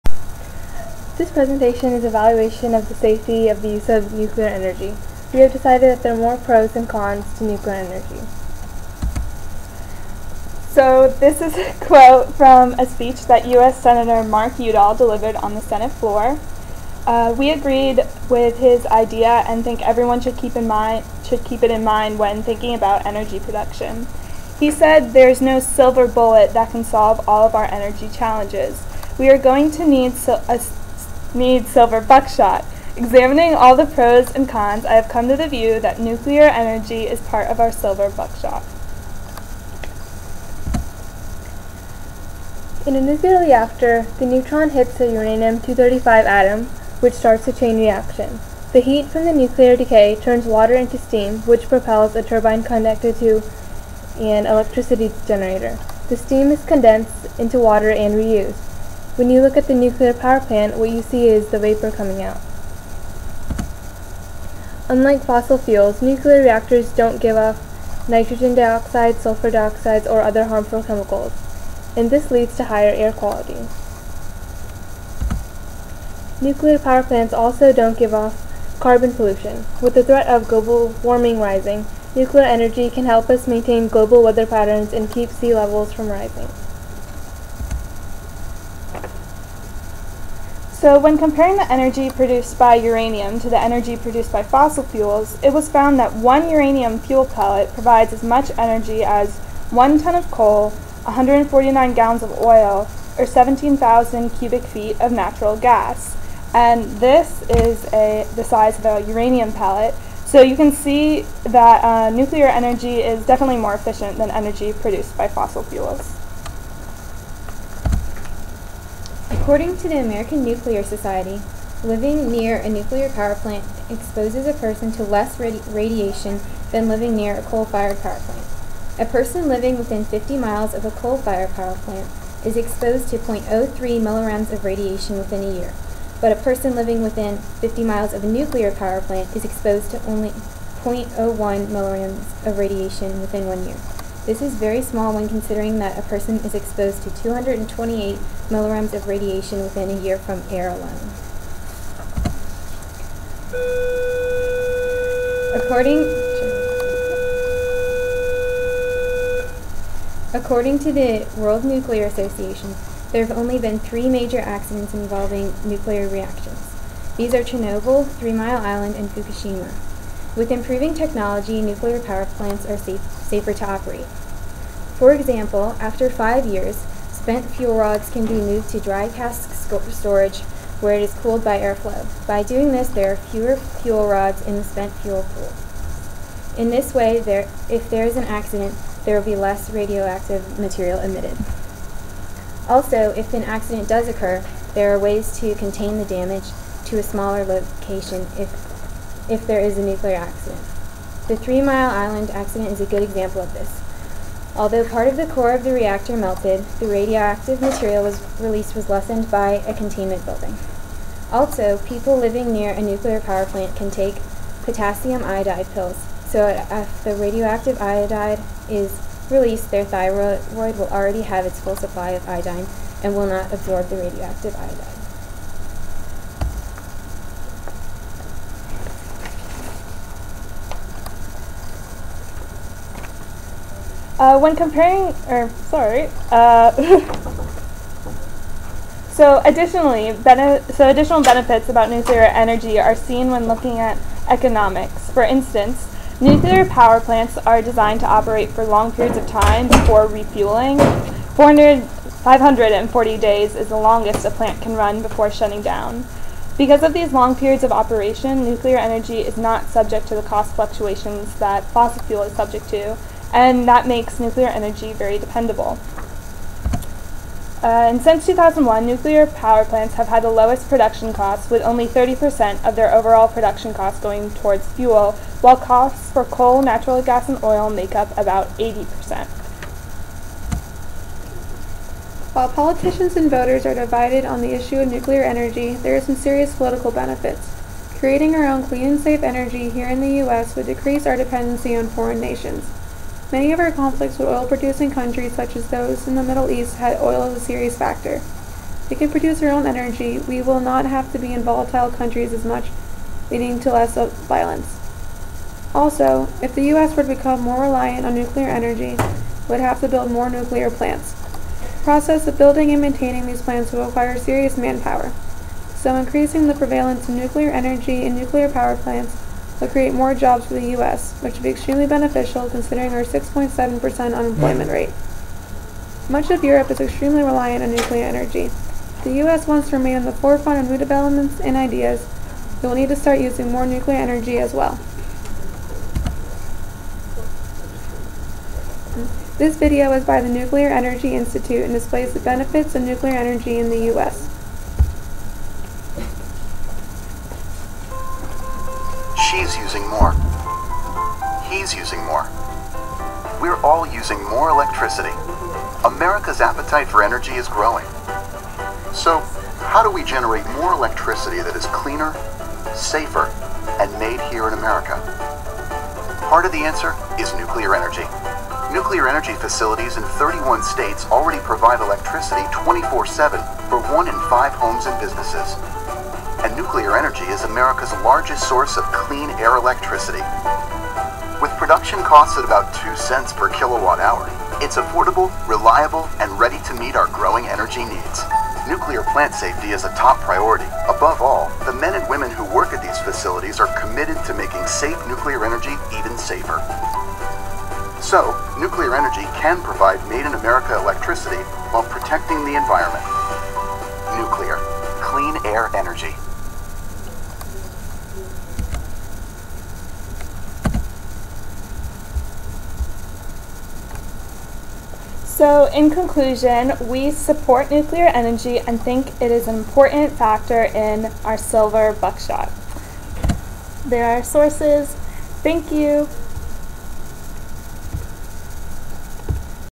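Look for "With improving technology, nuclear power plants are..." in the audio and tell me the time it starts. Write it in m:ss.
2:50.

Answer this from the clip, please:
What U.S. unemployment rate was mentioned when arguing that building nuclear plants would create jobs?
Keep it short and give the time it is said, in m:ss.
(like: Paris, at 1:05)
6.7%, at 5:23.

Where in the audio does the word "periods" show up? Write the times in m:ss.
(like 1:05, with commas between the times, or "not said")
4:08, 4:17.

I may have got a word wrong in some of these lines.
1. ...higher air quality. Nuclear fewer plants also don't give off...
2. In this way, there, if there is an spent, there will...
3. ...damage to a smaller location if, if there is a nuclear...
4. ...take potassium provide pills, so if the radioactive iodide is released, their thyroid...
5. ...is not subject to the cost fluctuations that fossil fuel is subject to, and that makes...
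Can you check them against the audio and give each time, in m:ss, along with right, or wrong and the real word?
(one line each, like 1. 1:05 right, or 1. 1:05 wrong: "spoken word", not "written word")
1. 1:12 wrong: "power", not "fewer"
2. 3:06 wrong: "accident", not "spent"
3. 3:16 right
4. 3:33 wrong: "iodide", not "provide"
5. 4:19 right.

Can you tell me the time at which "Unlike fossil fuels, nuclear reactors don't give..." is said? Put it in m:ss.
1:04.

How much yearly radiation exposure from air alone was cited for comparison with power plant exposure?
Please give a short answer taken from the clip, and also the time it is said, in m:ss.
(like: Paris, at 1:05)
228 millirems, at 2:27.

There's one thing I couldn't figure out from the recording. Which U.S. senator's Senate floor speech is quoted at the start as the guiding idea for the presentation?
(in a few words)
Mark Udall.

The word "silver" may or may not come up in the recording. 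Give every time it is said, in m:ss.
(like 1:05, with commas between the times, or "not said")
0:25, 0:31, 0:37, 7:01.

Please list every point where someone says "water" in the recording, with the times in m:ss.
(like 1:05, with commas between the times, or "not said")
0:50, 0:57.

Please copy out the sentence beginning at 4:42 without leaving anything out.
While politicians and voters are divided on the issue of nuclear energy, there are some serious political benefits.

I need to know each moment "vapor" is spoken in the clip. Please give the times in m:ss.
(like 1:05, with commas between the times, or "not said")
1:01.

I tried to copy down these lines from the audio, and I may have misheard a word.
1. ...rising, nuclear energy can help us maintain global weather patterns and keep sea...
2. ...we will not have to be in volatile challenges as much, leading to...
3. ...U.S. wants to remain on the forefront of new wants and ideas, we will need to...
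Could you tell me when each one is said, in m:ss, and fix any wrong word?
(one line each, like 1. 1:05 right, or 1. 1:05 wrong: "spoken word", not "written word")
1. 1:21 right
2. 5:00 wrong: "countries", not "challenges"
3. 5:29 wrong: "developments", not "wants".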